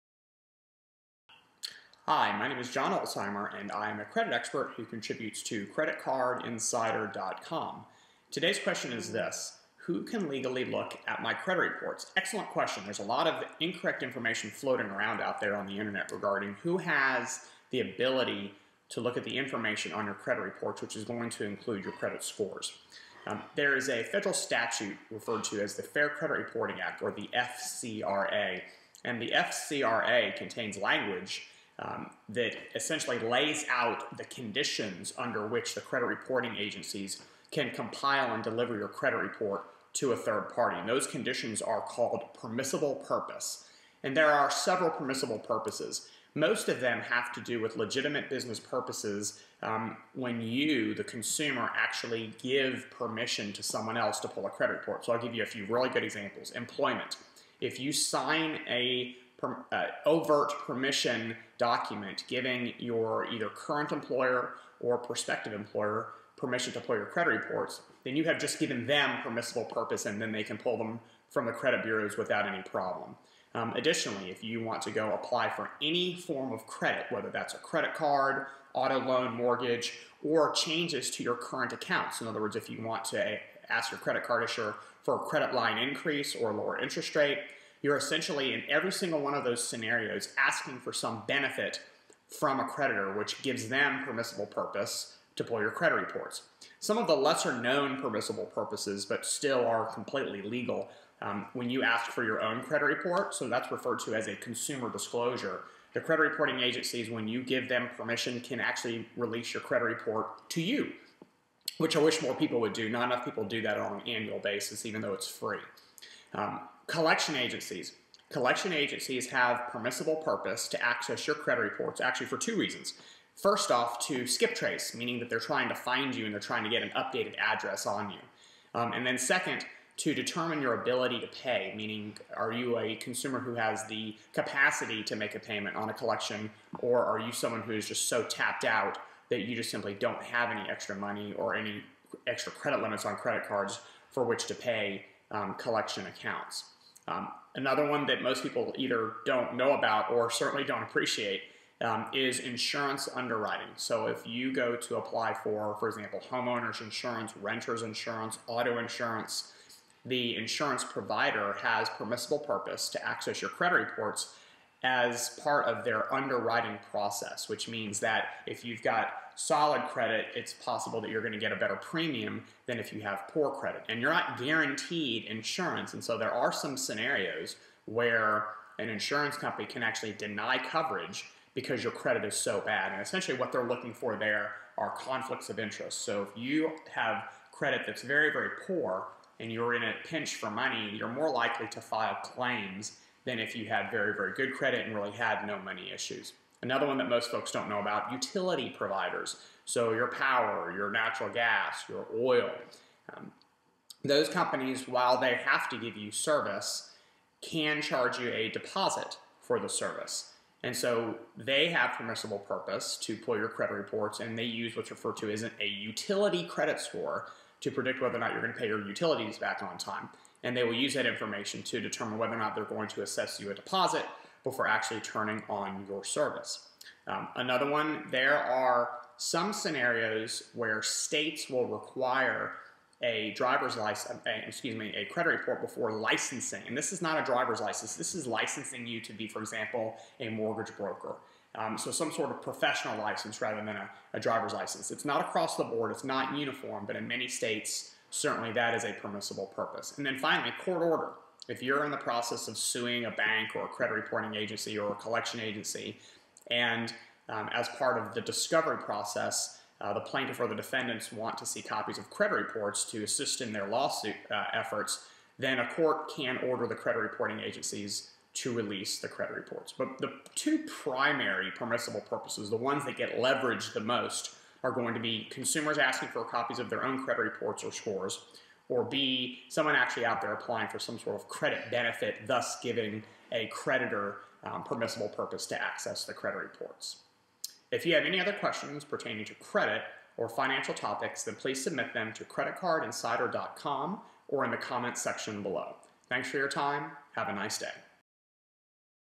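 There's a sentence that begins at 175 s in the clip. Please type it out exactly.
And so there are some scenarios where an insurance company can actually deny coverage because your credit is so bad.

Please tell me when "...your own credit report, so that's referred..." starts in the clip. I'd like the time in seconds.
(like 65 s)
102 s.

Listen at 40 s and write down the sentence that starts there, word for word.
And those conditions are called permissible purpose.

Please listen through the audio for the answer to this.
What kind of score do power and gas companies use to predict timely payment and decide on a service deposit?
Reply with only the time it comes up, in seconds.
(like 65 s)
215 s.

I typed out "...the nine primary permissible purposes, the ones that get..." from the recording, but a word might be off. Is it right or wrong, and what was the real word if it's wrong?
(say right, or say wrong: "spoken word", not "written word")
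wrong: "two", not "nine".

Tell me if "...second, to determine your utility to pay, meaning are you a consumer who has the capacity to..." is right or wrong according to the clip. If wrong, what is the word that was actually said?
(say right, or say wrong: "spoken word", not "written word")
wrong: "ability", not "utility".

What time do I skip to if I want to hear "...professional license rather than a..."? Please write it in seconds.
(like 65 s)
242 s.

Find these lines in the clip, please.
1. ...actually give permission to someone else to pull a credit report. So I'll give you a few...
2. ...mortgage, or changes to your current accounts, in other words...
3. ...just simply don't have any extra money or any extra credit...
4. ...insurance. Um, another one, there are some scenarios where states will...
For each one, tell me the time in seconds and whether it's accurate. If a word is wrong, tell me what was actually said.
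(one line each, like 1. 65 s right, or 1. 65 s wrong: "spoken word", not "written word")
1. 51 s right
2. 79 s right
3. 139 s right
4. 226 s wrong: "service", not "insurance".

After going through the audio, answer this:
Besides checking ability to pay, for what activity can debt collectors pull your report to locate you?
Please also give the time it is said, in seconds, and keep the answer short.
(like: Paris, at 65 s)
skip trace, at 124 s.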